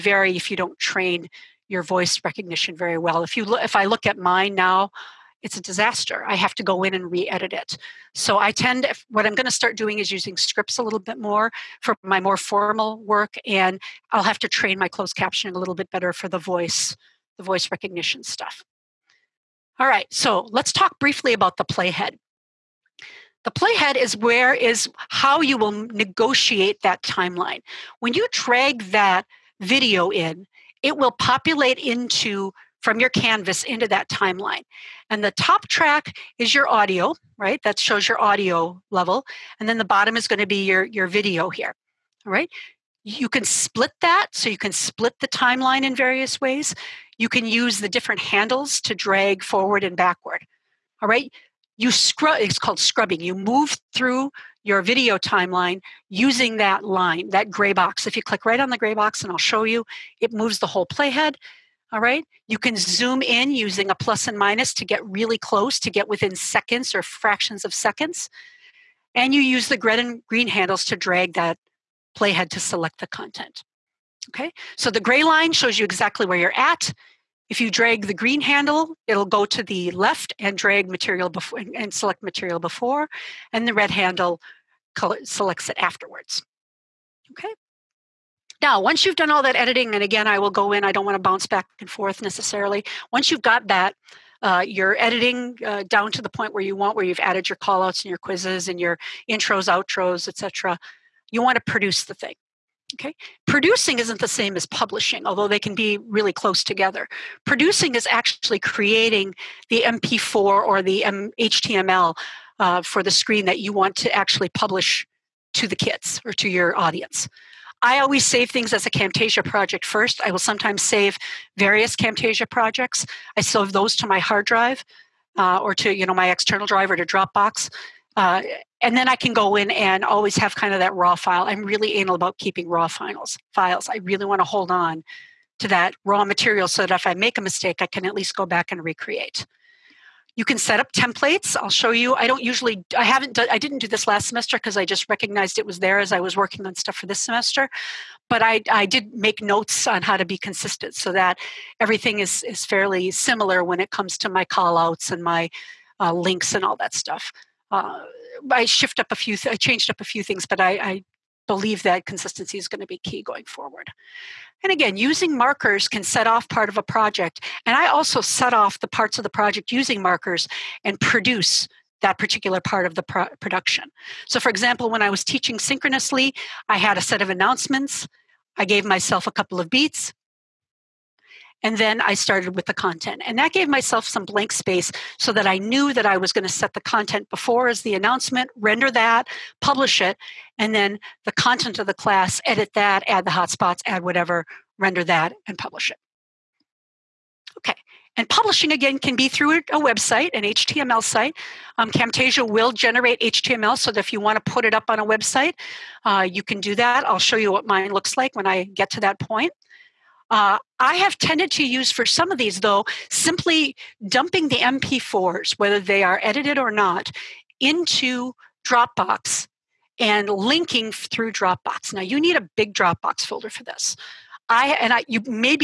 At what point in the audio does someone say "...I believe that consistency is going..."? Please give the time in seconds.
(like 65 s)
160 s.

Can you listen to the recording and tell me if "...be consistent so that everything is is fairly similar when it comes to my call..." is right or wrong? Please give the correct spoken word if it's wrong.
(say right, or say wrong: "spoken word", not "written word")
right.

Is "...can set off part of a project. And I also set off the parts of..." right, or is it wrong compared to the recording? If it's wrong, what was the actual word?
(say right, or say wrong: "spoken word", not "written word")
right.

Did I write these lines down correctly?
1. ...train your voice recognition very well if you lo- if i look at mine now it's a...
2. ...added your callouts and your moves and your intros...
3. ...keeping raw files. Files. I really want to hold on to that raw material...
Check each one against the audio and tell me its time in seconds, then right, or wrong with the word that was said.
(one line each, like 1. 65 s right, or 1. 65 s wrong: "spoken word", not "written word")
1. 0 s right
2. 97 s wrong: "quizzes", not "moves"
3. 132 s right.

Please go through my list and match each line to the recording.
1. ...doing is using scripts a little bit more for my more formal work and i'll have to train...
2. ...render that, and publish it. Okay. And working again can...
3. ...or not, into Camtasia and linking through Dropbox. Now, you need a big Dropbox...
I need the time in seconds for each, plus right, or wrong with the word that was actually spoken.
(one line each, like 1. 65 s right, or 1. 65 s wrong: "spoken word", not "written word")
1. 9 s right
2. 194 s wrong: "publishing", not "working"
3. 216 s wrong: "Dropbox", not "Camtasia".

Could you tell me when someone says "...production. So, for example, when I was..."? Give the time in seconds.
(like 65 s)
173 s.